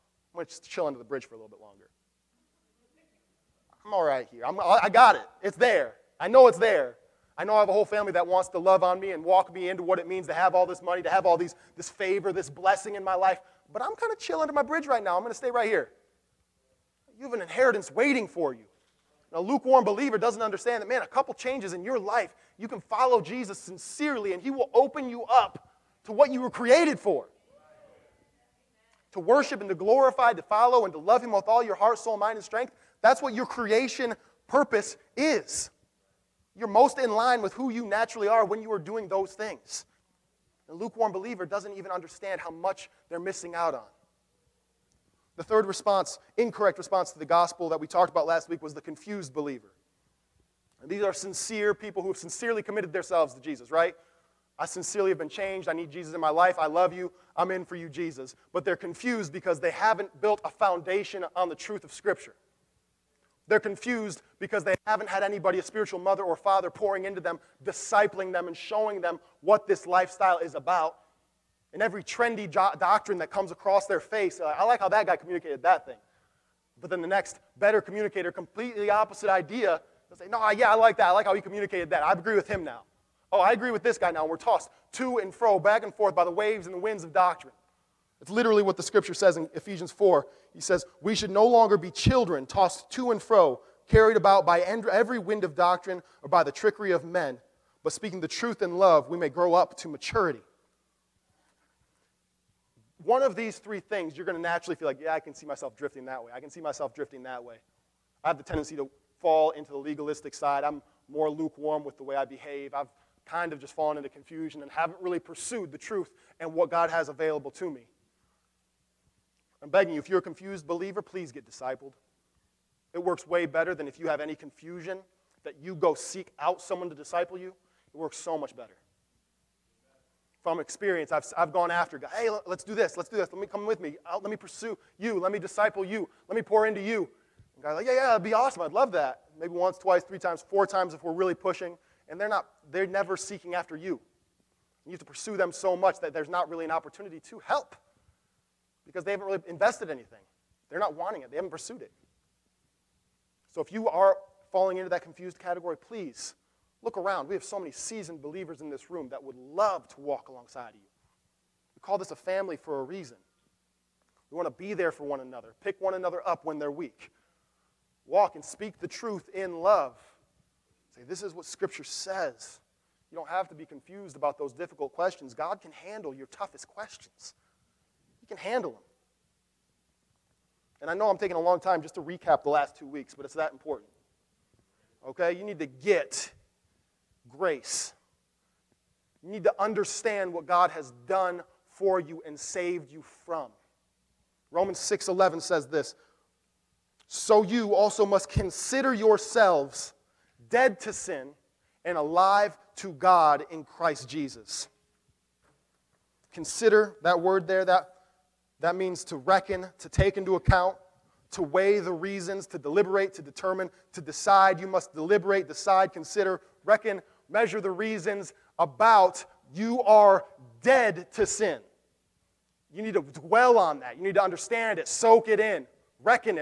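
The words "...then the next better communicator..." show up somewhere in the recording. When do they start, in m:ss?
1:16.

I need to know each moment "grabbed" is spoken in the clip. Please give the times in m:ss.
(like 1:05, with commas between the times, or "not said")
not said.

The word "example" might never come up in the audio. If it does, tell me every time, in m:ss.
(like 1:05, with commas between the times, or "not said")
not said.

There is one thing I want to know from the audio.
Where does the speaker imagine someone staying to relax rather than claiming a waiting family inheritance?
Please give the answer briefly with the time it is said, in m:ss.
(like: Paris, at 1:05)
Under the bridge, at 0:00.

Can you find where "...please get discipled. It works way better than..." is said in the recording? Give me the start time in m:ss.
2:00.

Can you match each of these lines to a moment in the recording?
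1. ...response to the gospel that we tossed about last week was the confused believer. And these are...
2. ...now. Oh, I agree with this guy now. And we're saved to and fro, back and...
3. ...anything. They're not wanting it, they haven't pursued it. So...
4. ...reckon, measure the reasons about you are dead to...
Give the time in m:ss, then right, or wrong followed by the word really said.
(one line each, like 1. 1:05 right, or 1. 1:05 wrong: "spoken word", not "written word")
1. 0:46 wrong: "talked", not "tossed"
2. 1:22 wrong: "tossed", not "saved"
3. 2:29 right
4. 3:36 right.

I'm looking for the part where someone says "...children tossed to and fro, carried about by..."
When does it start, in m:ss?
1:31.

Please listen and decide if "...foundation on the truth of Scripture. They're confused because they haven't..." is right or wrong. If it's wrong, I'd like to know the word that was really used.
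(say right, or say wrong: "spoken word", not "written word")
right.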